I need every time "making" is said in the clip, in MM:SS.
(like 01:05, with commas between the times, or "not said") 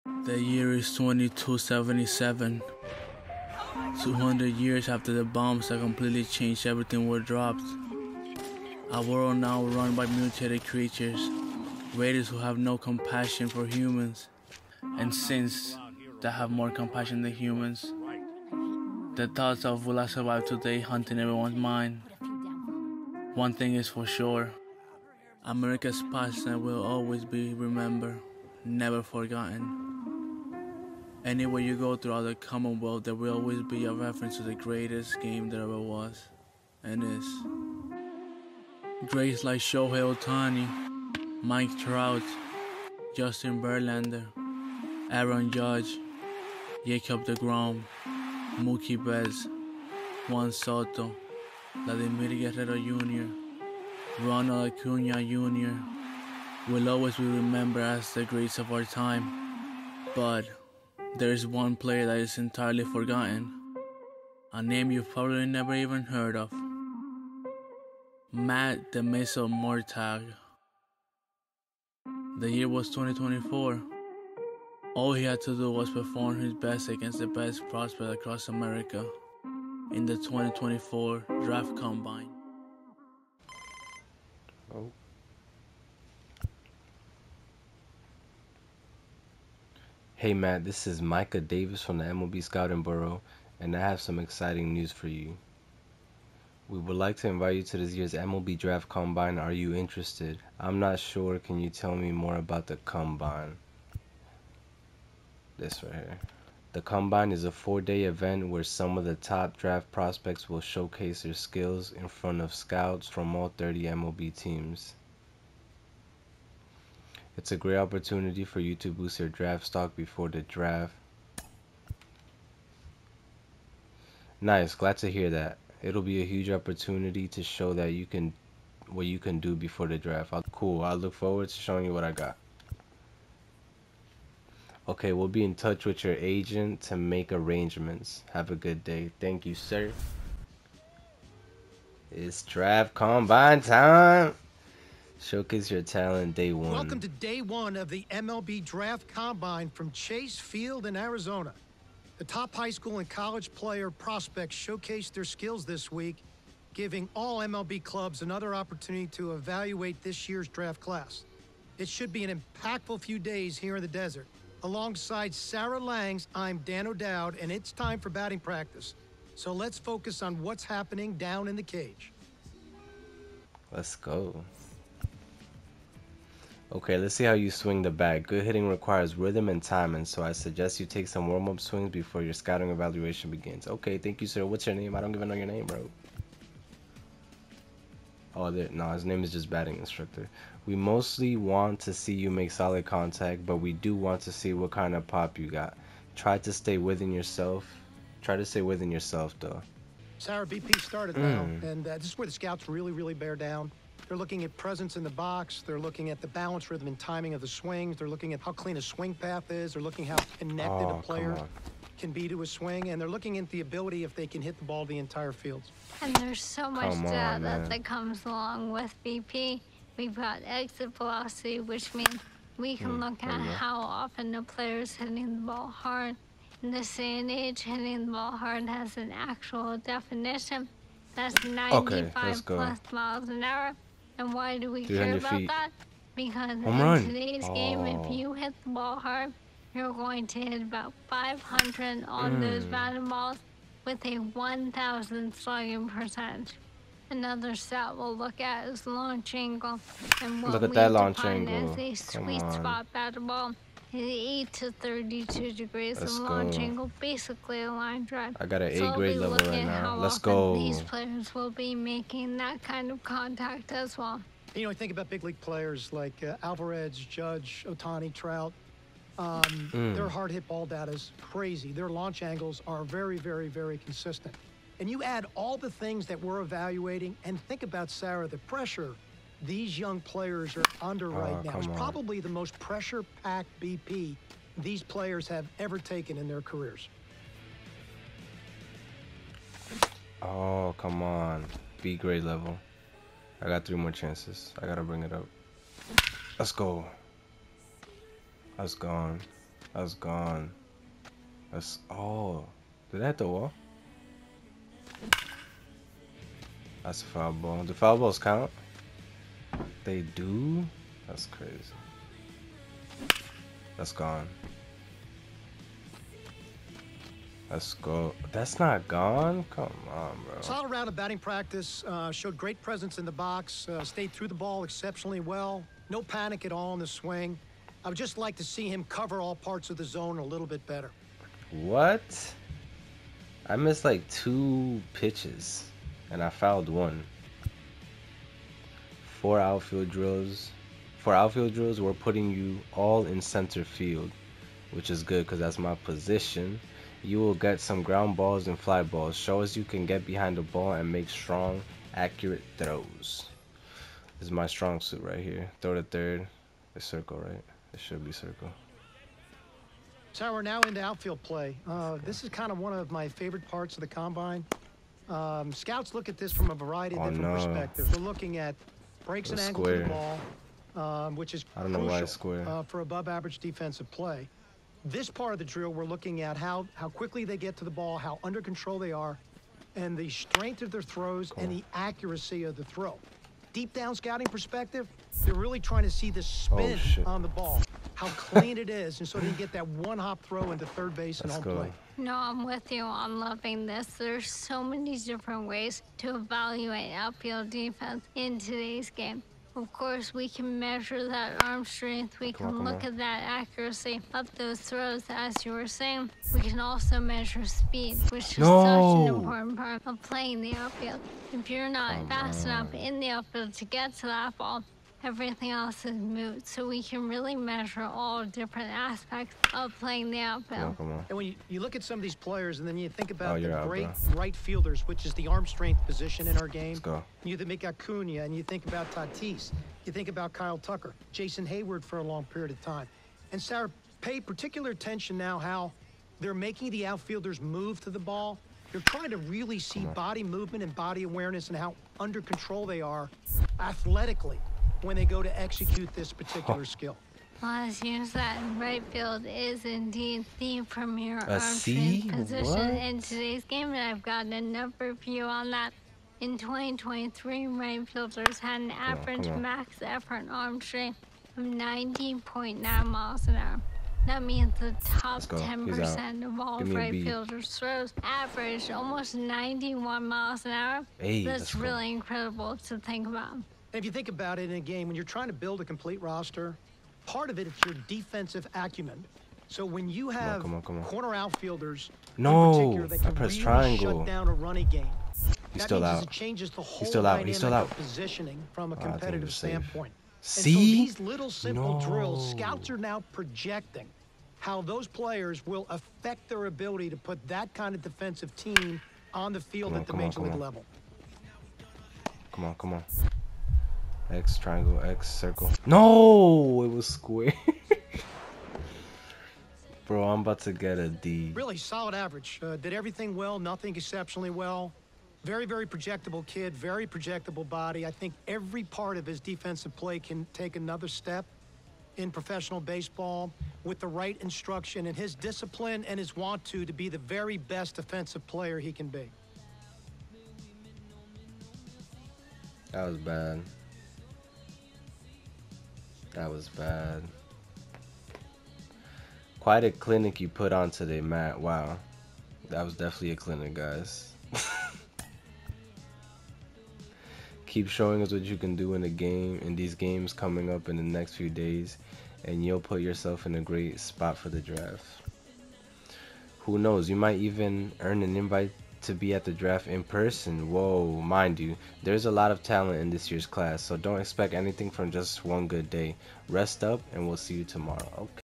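04:21, 07:16.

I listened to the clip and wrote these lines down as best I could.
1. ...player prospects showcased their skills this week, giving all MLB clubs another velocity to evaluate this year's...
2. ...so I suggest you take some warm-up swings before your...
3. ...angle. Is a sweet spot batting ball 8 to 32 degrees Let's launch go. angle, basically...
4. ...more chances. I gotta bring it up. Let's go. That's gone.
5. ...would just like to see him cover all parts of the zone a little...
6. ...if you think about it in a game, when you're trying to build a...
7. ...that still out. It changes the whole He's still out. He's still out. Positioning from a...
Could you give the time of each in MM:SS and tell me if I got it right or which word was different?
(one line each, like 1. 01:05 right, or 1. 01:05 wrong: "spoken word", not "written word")
1. 02:33 wrong: "opportunity", not "velocity"
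2. 03:00 right
3. 04:11 right
4. 04:53 right
5. 05:27 right
6. 07:53 right
7. 08:05 right.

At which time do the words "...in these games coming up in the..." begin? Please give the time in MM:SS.
09:09.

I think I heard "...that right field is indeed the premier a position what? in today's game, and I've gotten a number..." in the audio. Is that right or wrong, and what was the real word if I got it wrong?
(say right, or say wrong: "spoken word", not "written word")
right.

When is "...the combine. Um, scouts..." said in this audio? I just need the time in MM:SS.
06:03.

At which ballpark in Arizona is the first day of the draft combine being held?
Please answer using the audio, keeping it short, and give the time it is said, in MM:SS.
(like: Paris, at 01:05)
Chase Field, at 02:29.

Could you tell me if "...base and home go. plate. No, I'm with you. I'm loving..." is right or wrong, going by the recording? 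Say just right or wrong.
right.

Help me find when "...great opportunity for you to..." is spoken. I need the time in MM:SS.
01:57.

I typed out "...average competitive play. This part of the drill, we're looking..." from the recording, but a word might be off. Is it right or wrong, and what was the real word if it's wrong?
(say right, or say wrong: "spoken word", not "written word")
wrong: "defensive", not "competitive".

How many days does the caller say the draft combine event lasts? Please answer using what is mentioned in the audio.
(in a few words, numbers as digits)
4.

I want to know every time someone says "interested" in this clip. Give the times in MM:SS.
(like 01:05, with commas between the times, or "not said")
01:39.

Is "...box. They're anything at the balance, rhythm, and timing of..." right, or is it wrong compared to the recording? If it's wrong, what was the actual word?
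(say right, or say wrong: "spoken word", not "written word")
wrong: "looking", not "anything".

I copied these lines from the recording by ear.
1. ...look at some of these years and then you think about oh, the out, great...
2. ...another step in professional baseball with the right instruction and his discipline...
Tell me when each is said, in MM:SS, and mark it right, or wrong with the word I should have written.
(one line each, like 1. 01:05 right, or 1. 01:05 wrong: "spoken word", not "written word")
1. 07:01 wrong: "players", not "years"
2. 08:40 right.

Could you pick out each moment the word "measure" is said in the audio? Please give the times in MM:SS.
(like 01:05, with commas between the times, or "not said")
06:40, 06:47, 06:57.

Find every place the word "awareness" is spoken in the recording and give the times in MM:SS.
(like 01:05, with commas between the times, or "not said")
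07:21.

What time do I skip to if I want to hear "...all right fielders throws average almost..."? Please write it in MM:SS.
07:46.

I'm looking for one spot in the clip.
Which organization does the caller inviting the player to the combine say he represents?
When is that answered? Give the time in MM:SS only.
01:32.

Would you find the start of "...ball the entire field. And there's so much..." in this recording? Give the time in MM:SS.
03:34.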